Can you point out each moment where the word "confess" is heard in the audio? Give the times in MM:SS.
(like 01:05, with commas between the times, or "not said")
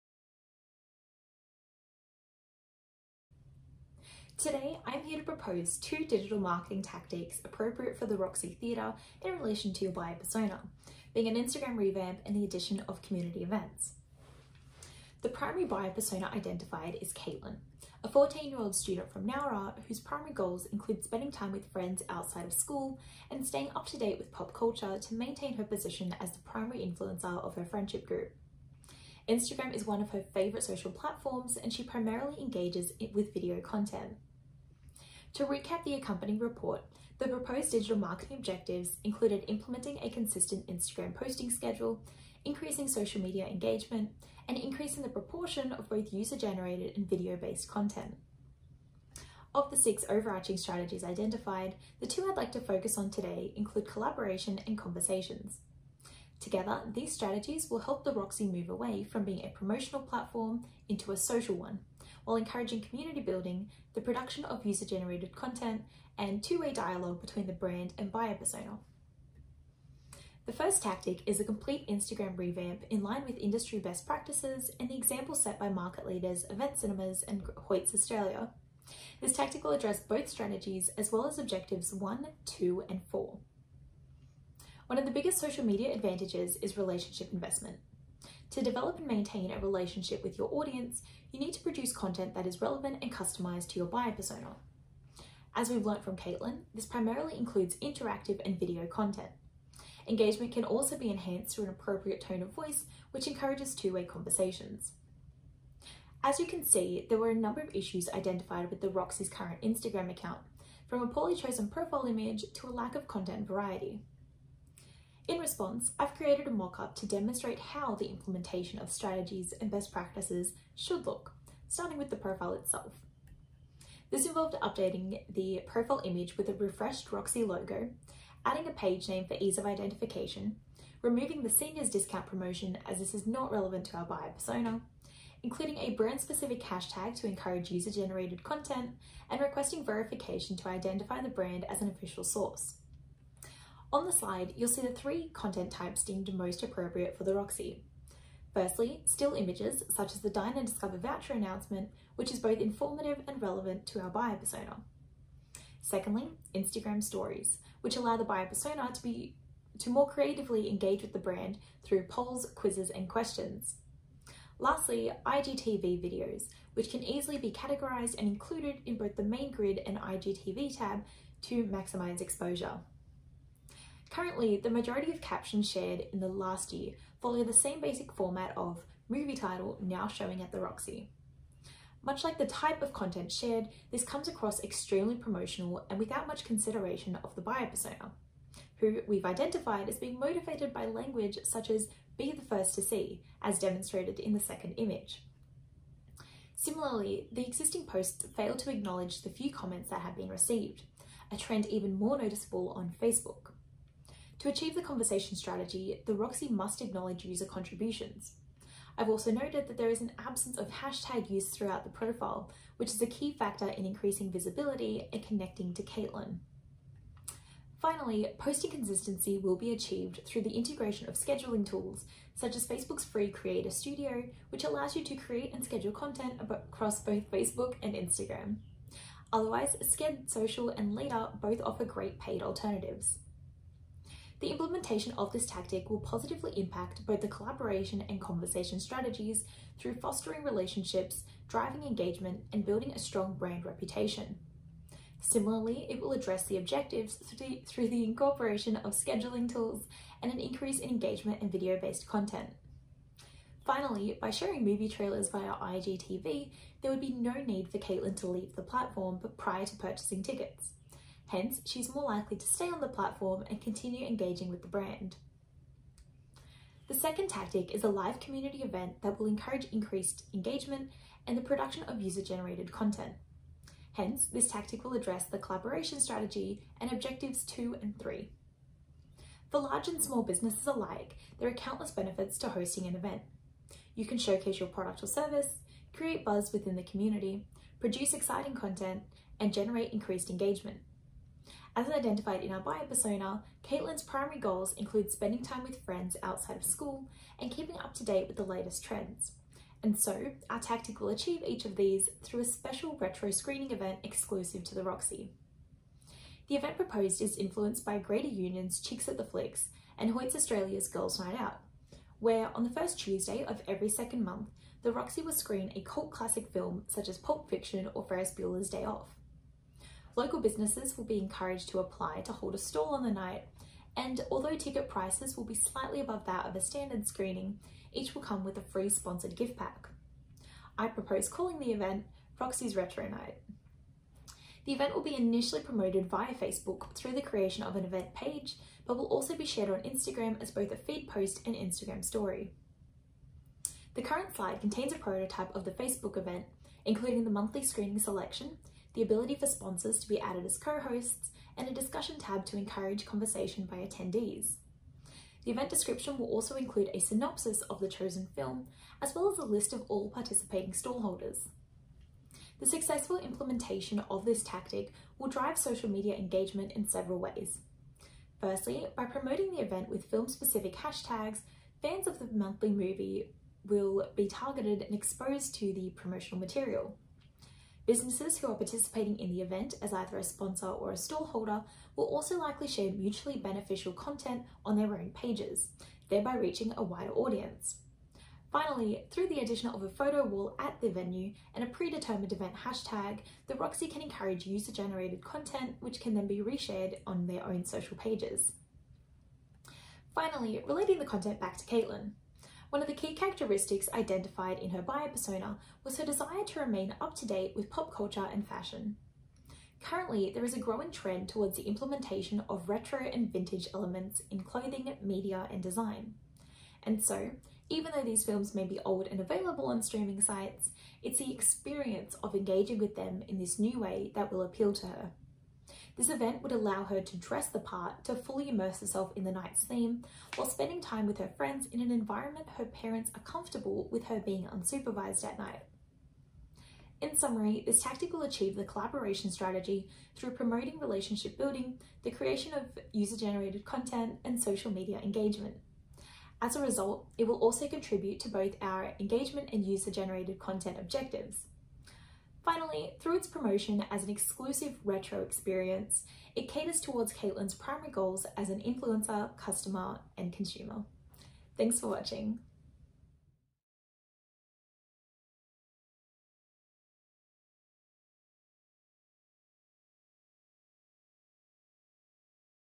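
not said.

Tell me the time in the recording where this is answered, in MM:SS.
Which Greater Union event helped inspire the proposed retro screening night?
05:08.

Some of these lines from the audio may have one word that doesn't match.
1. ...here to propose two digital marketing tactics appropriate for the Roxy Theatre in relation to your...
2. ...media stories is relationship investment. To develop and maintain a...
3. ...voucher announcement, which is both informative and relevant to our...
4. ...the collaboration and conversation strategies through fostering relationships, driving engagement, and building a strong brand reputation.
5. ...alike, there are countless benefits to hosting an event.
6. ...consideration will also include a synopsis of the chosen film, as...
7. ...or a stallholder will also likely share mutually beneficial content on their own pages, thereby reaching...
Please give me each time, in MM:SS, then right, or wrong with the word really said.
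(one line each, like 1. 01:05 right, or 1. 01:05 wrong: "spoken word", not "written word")
1. 00:05 right
2. 01:25 wrong: "advantages", not "stories"
3. 02:30 right
4. 03:57 right
5. 04:40 right
6. 05:55 wrong: "description", not "consideration"
7. 06:20 right.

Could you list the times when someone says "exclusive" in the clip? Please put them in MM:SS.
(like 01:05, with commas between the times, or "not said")
05:04, 07:34.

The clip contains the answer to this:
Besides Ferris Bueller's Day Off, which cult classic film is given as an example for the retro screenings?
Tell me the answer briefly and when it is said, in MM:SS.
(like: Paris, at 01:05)
Pulp Fiction, at 05:17.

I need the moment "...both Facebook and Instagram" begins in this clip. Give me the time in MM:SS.
03:46.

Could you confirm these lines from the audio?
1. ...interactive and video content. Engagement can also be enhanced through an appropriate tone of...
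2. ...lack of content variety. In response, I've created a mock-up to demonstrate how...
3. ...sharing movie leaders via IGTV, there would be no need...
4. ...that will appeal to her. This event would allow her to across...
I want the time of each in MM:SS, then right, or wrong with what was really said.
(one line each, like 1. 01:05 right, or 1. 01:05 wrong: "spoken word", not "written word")
1. 01:37 right
2. 01:52 right
3. 04:14 wrong: "trailers", not "leaders"
4. 07:04 wrong: "dress", not "across".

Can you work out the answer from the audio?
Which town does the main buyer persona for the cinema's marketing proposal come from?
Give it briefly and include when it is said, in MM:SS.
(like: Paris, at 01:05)
Nowra, at 00:19.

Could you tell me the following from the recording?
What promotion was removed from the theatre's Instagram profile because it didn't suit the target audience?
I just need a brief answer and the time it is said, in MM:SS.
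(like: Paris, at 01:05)
seniors discount, at 02:11.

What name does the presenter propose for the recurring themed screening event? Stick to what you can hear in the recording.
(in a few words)
Roxy's Retro Night.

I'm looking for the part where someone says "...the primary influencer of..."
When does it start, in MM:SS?
00:26.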